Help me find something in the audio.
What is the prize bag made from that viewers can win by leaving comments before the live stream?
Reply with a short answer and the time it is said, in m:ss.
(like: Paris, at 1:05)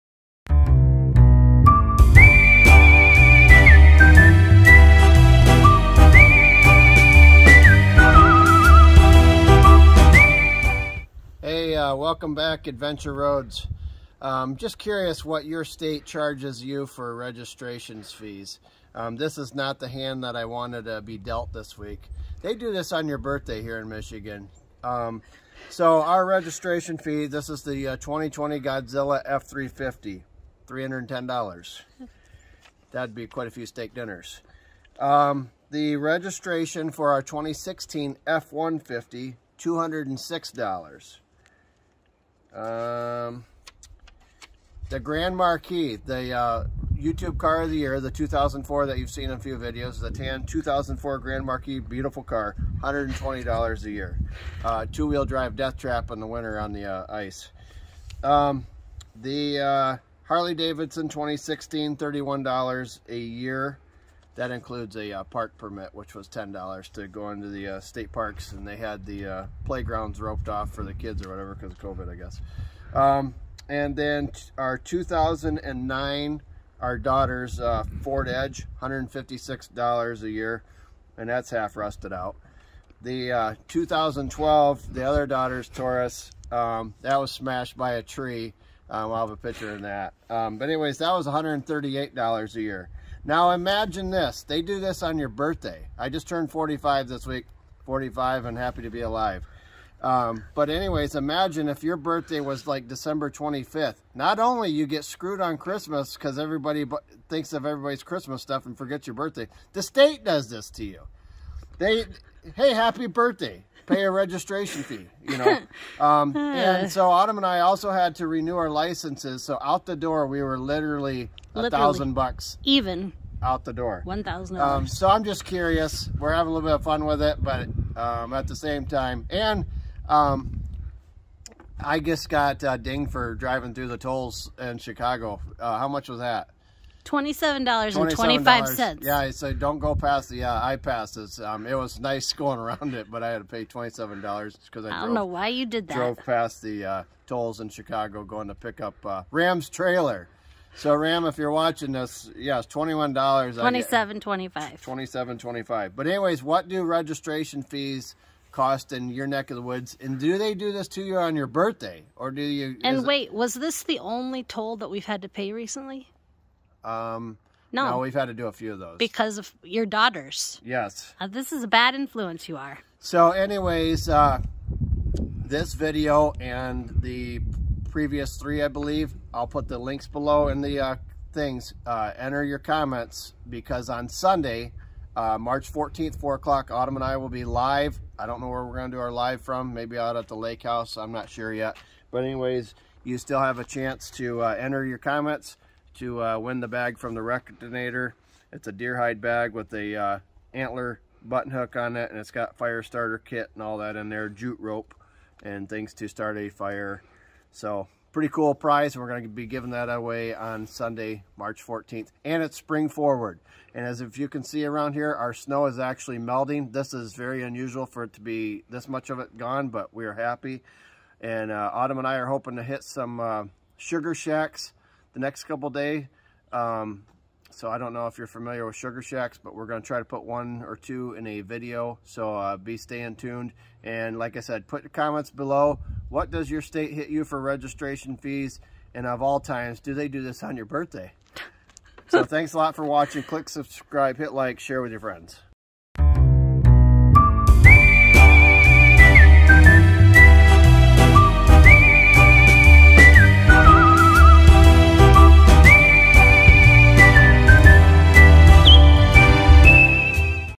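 deer hide, at 3:18.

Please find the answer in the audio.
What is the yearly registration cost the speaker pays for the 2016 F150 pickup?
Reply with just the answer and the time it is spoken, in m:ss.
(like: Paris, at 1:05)
$206, at 0:39.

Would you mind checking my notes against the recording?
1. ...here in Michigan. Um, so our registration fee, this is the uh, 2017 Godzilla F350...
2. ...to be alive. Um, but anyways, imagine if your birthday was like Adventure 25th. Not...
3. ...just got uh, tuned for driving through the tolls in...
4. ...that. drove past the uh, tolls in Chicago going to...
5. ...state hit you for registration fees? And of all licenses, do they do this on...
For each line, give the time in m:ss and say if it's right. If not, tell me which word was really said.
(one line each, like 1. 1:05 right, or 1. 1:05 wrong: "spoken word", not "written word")
1. 0:23 wrong: "2020", not "2017"
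2. 1:38 wrong: "December", not "Adventure"
3. 2:11 wrong: "dinged", not "tuned"
4. 2:25 right
5. 3:56 wrong: "times", not "licenses".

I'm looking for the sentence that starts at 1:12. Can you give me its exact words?
Um, and then our 2009, our daughter's uh, Ford Edge, $156 a year, and that's half rusted out.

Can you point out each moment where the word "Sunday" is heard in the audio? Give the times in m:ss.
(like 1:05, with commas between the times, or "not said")
3:04, 3:30.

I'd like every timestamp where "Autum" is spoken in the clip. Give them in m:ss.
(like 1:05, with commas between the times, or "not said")
1:57, 3:06, 3:41.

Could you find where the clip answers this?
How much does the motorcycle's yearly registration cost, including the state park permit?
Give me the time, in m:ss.
1:01.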